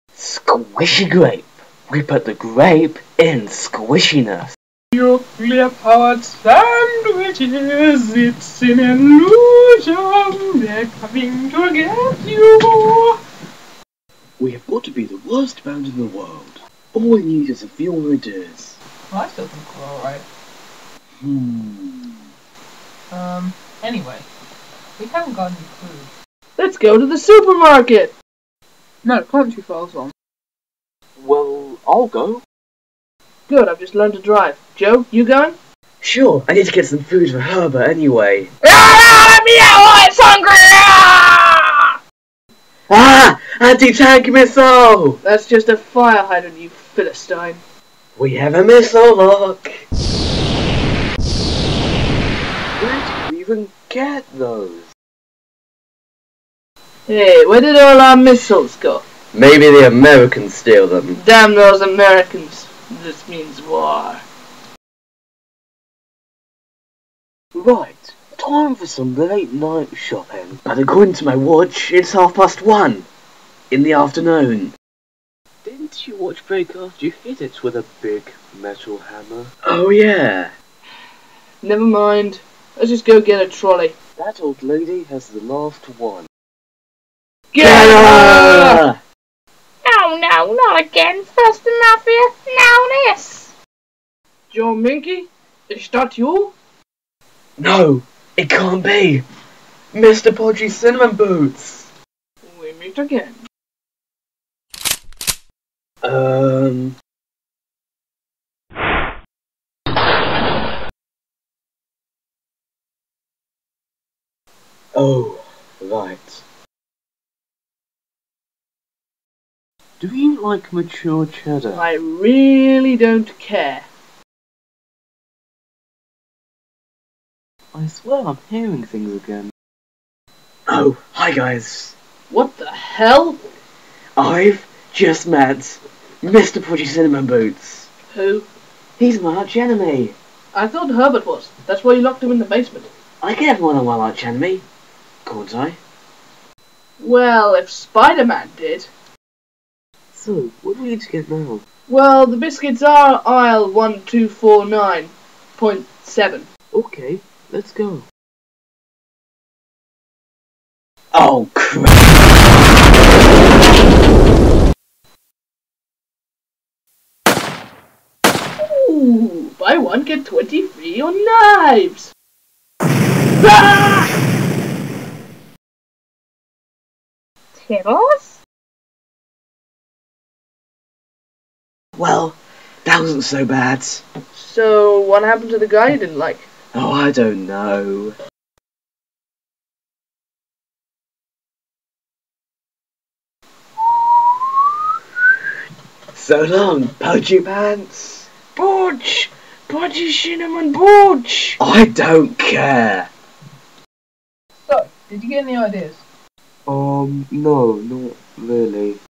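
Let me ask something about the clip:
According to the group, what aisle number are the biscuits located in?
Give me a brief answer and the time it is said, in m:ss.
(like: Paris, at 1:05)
1249.7, at 2:33.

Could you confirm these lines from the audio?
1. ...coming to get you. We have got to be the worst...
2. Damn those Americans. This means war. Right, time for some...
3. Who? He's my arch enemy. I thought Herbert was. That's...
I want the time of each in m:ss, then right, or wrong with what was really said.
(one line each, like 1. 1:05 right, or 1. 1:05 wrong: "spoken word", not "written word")
1. 0:10 right
2. 1:01 right
3. 2:18 right.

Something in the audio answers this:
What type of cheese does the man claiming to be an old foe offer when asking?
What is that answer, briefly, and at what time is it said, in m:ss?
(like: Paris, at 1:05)
Mature cheddar, at 2:00.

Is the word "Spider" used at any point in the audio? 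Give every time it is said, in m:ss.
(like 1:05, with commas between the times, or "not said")
2:27.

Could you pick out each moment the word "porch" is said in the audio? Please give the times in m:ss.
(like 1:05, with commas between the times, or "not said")
not said.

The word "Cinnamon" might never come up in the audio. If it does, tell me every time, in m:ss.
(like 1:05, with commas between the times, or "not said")
1:40, 2:16, 3:20.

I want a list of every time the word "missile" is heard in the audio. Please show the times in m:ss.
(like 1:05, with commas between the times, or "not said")
0:44, 0:48, 0:58.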